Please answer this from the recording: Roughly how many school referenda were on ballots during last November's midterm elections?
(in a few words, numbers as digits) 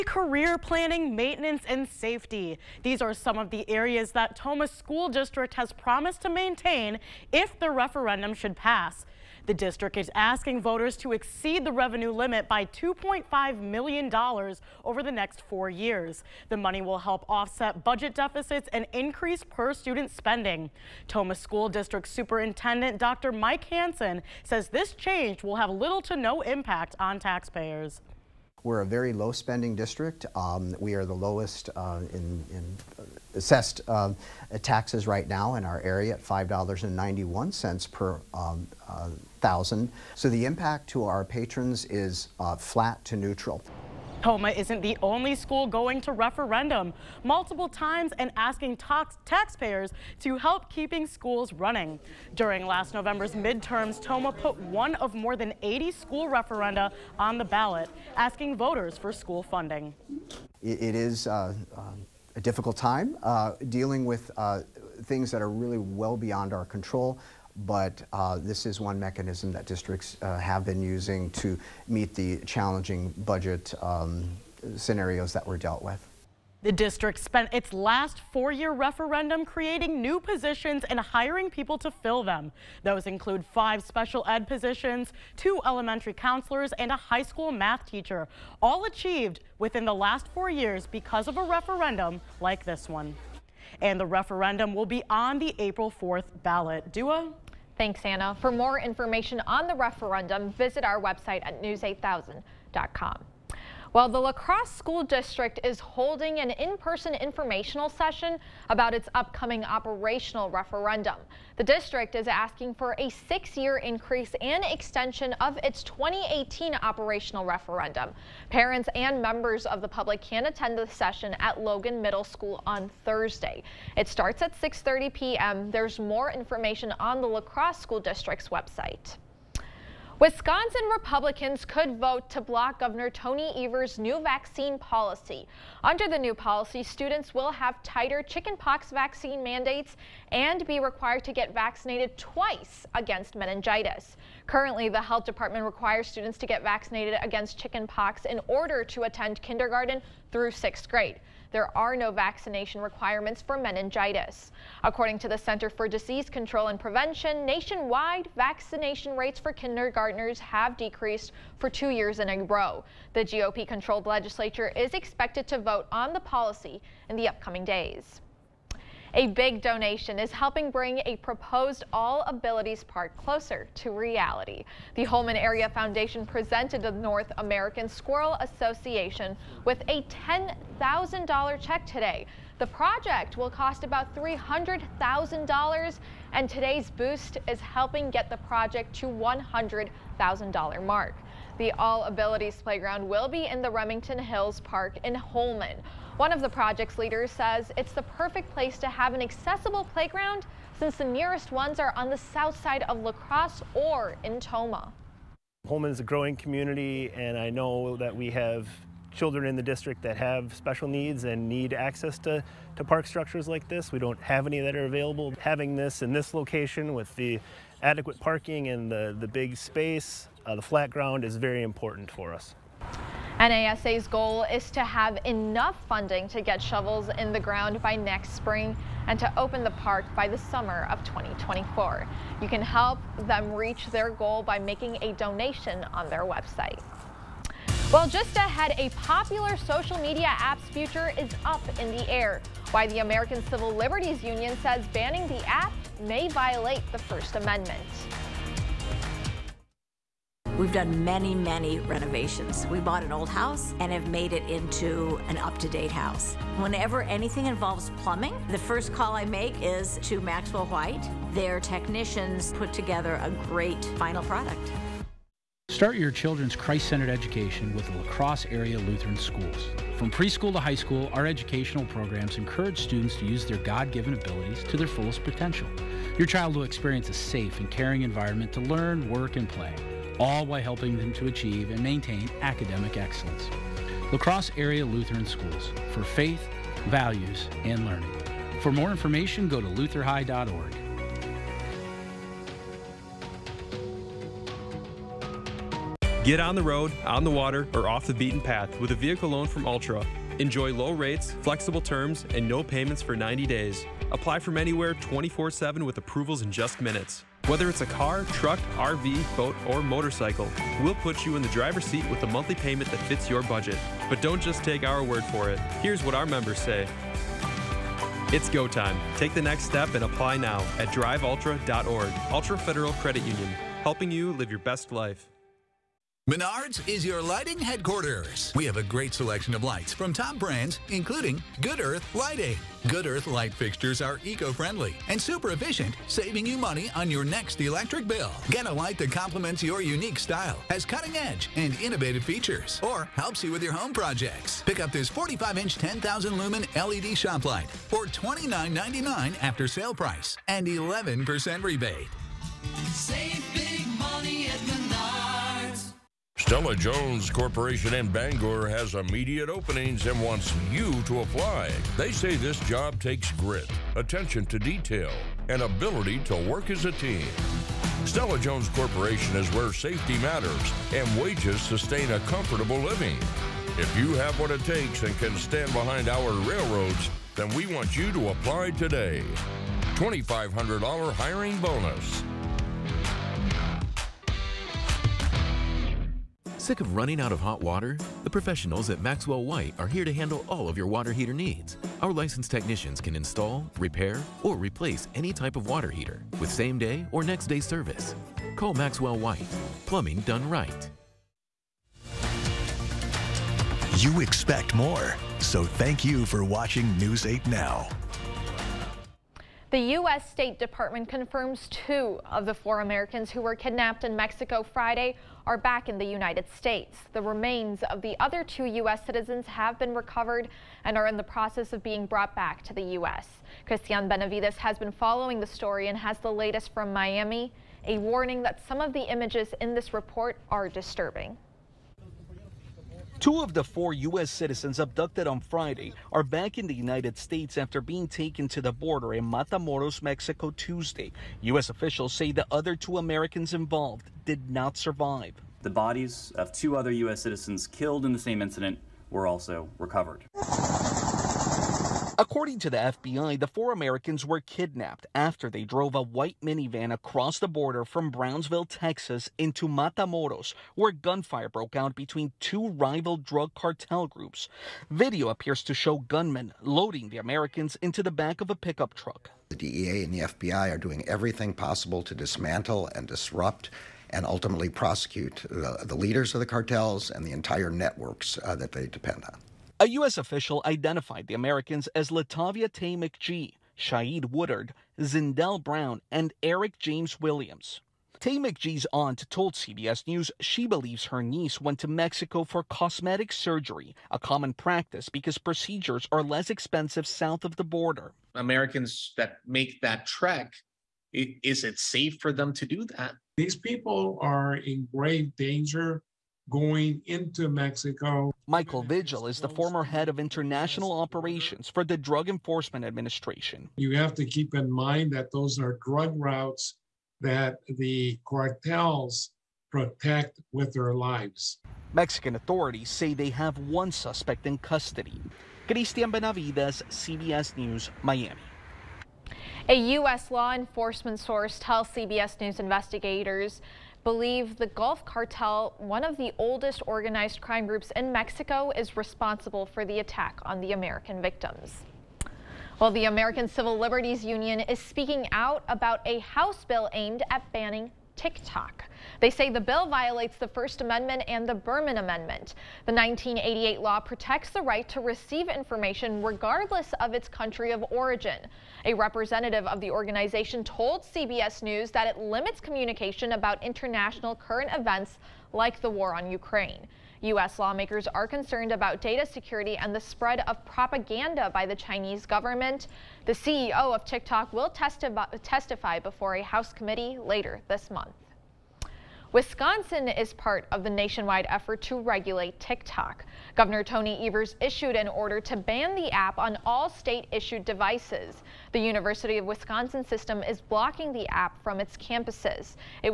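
more than 80.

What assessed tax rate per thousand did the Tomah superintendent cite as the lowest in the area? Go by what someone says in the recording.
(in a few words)
$5.91.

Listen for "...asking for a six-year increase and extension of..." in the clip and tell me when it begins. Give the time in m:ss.
1:52.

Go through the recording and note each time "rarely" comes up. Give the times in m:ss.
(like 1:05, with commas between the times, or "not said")
not said.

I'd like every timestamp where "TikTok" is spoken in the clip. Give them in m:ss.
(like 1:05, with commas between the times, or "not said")
9:08, 9:34, 9:42.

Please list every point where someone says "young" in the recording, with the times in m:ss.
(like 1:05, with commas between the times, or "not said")
not said.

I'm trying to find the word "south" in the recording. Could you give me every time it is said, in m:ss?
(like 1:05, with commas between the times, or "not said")
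3:22, 8:17.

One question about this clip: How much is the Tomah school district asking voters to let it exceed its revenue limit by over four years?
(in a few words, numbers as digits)
$2.5 million.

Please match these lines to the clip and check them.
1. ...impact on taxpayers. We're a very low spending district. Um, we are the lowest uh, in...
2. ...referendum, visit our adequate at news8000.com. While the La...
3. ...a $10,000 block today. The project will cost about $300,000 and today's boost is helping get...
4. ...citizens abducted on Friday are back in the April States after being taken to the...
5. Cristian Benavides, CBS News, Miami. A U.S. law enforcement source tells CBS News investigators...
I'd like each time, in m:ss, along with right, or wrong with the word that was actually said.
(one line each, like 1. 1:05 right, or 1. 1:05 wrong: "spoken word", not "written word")
1. 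0:26 right
2. 1:39 wrong: "website", not "adequate"
3. 2:59 wrong: "check", not "block"
4. 7:14 wrong: "United", not "April"
5. 8:45 right.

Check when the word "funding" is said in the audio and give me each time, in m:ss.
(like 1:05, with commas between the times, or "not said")
0:59, 3:45.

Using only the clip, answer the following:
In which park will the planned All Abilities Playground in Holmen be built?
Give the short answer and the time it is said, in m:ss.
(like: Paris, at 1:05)
Remington Hills Park, at 3:13.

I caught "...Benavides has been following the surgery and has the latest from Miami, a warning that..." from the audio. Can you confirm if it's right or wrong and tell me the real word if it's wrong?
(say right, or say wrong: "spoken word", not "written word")
wrong: "story", not "surgery".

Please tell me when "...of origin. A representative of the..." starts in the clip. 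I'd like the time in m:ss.
9:17.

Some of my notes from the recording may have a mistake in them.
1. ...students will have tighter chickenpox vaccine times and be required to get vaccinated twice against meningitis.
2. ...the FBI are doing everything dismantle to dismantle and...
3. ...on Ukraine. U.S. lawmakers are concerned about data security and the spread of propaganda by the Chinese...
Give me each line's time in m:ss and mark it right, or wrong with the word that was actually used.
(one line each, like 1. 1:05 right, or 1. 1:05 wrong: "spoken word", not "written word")
1. 2:16 wrong: "mandates", not "times"
2. 7:50 wrong: "possible", not "dismantle"
3. 9:26 right.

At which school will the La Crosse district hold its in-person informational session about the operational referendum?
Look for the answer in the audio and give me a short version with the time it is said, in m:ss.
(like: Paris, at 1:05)
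Logan Middle School, at 2:01.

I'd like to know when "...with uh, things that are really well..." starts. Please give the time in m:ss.
1:04.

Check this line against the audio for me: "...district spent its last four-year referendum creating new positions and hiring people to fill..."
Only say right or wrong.
right.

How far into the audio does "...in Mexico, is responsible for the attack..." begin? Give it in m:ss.
8:57.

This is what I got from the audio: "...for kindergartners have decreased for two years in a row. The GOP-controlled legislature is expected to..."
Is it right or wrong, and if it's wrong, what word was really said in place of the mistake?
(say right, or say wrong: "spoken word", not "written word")
right.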